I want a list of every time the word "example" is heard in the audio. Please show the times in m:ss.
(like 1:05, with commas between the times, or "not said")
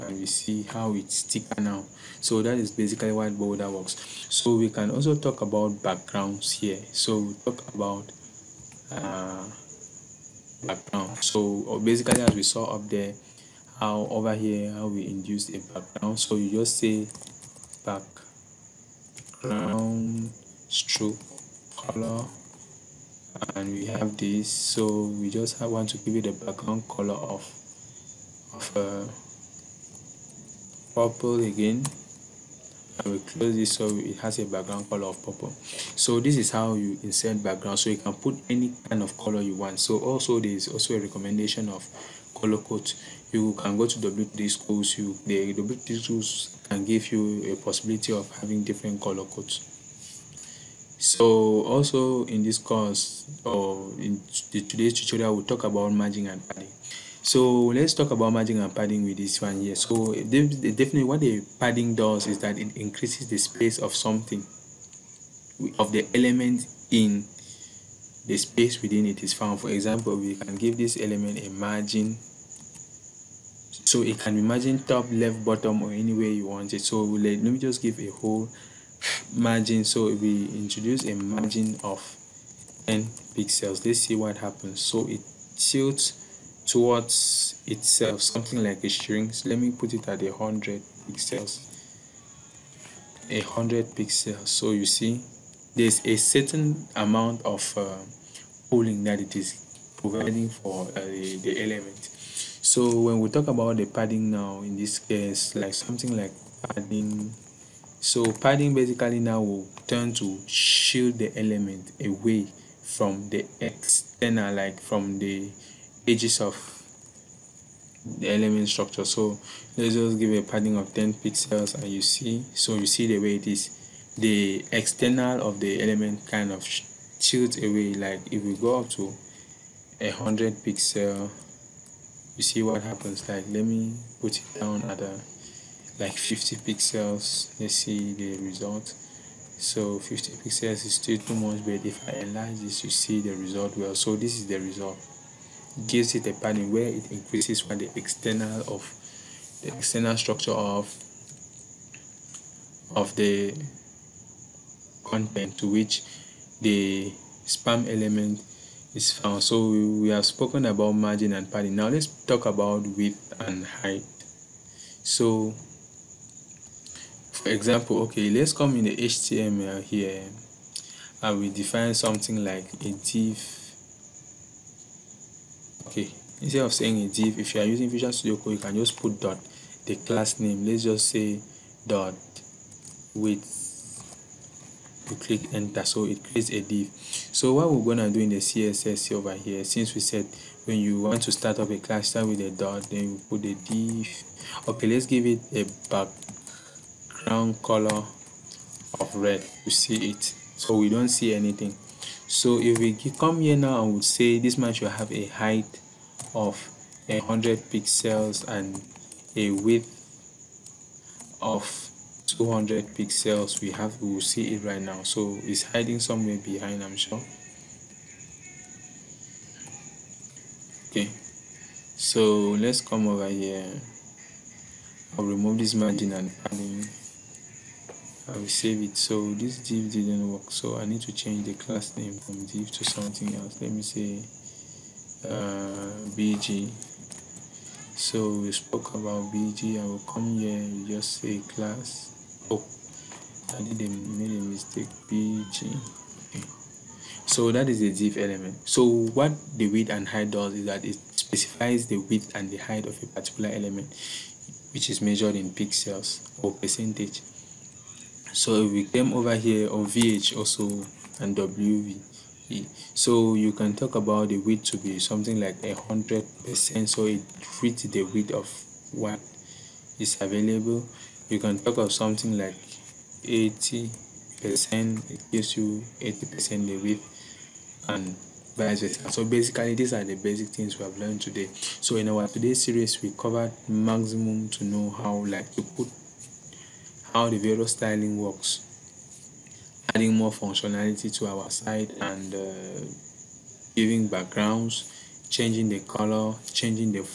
1:09, 2:47.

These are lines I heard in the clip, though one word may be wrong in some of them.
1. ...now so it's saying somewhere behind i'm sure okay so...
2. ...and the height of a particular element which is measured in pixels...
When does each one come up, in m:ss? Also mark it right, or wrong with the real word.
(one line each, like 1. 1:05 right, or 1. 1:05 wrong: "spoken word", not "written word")
1. 3:34 wrong: "hiding", not "saying"
2. 4:12 right.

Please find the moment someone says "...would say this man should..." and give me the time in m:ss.
3:23.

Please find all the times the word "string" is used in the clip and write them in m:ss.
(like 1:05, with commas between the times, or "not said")
1:28.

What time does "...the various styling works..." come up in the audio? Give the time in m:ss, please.
4:47.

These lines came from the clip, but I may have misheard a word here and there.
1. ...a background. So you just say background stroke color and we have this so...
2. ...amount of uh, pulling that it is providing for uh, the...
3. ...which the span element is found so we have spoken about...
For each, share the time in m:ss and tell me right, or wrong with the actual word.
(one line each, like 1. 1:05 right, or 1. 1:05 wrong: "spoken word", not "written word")
1. 0:15 right
2. 1:36 right
3. 2:35 right.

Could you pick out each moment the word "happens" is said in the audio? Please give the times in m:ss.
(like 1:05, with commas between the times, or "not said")
1:24, 2:12.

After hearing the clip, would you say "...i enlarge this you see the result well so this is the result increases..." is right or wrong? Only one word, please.
wrong.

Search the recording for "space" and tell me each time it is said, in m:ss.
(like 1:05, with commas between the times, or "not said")
1:03, 1:08.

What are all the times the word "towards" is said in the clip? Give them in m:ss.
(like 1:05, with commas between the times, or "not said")
1:26.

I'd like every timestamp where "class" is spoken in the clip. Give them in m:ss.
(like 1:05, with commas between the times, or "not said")
2:59, 3:11, 3:51, 4:01.